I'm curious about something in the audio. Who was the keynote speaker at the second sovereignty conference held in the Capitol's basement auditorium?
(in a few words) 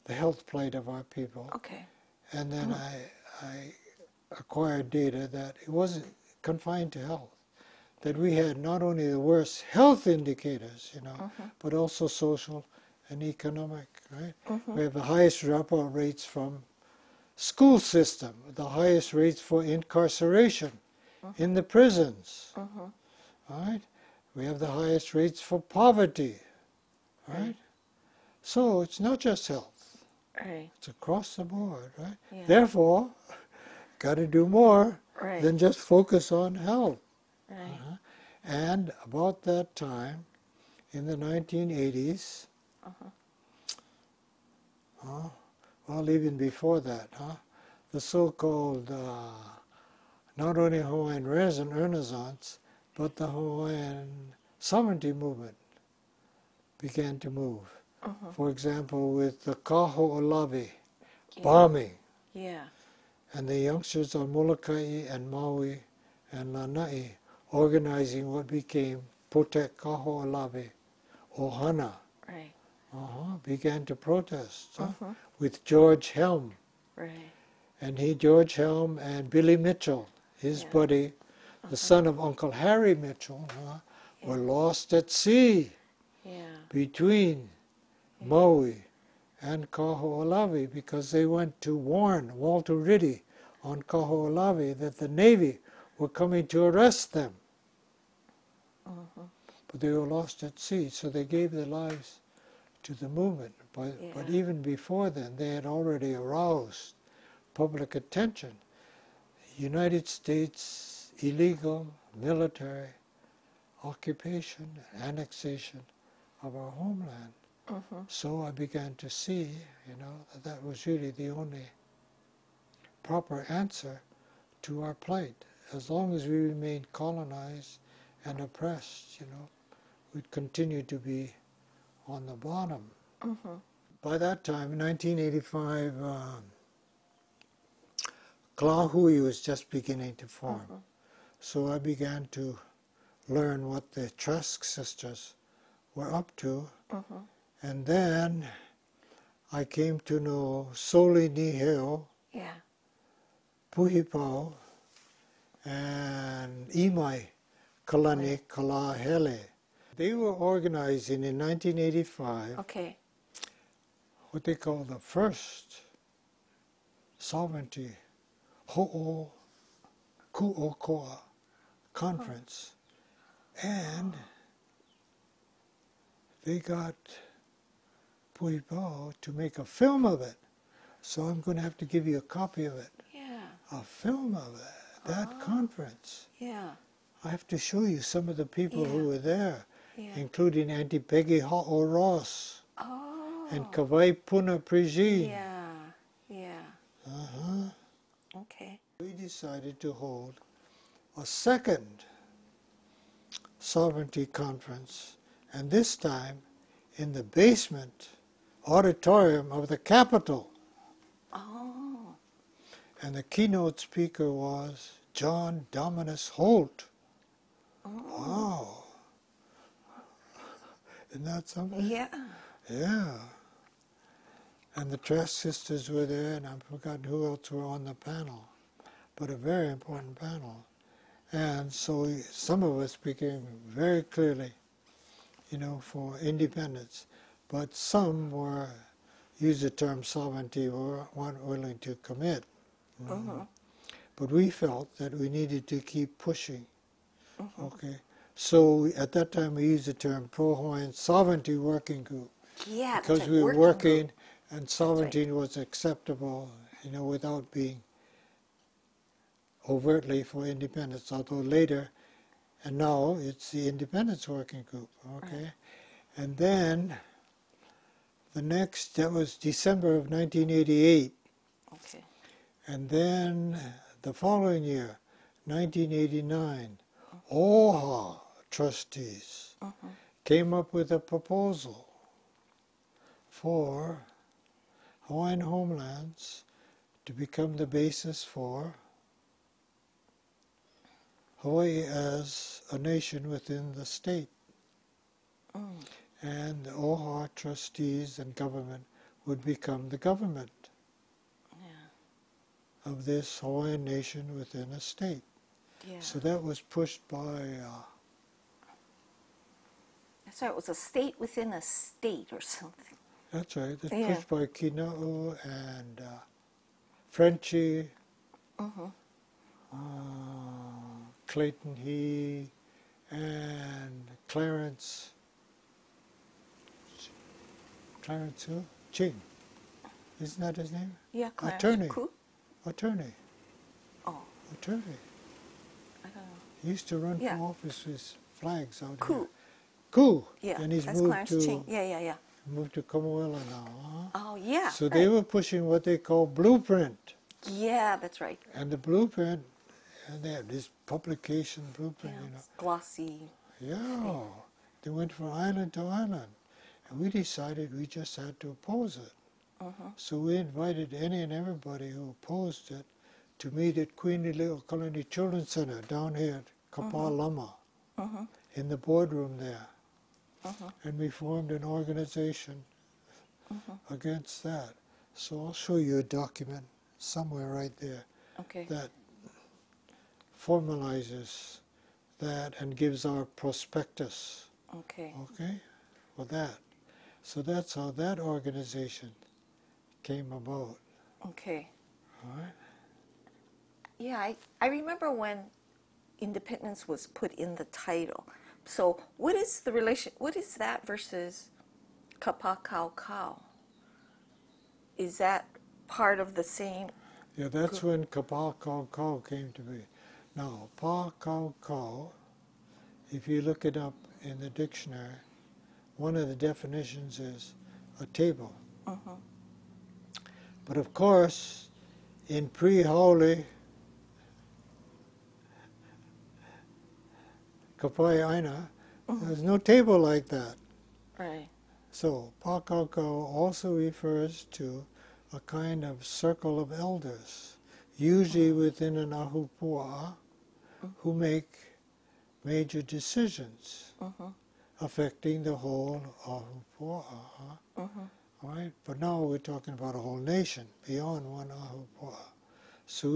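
John Dominis Holt.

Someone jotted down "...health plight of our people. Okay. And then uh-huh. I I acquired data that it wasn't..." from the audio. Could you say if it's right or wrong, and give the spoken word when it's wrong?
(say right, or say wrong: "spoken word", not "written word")
right.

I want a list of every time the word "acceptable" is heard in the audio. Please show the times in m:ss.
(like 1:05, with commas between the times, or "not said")
4:15.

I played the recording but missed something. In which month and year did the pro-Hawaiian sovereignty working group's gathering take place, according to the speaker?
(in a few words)
December 1988.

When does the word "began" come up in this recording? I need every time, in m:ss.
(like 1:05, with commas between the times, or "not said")
0:56, 1:13, 1:58, 2:21.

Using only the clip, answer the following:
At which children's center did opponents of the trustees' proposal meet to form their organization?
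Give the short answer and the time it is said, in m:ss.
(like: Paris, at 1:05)
Queen Lili'uokalani Children's Center, at 6:03.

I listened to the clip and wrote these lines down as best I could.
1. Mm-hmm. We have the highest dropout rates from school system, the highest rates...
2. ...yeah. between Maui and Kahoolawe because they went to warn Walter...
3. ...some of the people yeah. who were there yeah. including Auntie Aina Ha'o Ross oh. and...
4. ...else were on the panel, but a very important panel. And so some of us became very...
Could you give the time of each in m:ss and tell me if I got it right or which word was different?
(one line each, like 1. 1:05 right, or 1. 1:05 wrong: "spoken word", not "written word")
1. 0:14 right
2. 1:26 right
3. 3:07 wrong: "Peggy", not "Aina"
4. 3:47 right.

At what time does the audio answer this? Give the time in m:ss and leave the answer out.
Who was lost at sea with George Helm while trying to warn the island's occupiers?
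1:19.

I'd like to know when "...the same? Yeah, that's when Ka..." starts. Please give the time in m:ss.
6:46.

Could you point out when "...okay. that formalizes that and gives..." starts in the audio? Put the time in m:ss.
6:18.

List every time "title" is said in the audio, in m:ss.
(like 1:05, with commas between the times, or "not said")
6:37.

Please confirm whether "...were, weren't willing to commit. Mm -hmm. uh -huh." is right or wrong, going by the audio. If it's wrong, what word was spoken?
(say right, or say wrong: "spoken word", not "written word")
right.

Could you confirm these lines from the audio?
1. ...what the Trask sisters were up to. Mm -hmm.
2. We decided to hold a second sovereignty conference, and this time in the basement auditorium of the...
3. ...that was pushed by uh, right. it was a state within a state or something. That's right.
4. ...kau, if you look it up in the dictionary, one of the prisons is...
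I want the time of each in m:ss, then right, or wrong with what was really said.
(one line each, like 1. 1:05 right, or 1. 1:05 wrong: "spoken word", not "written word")
1. 2:23 right
2. 3:19 right
3. 5:06 right
4. 6:51 wrong: "definitions", not "prisons".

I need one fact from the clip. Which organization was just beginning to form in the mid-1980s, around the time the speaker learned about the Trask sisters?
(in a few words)
Ka Lahui.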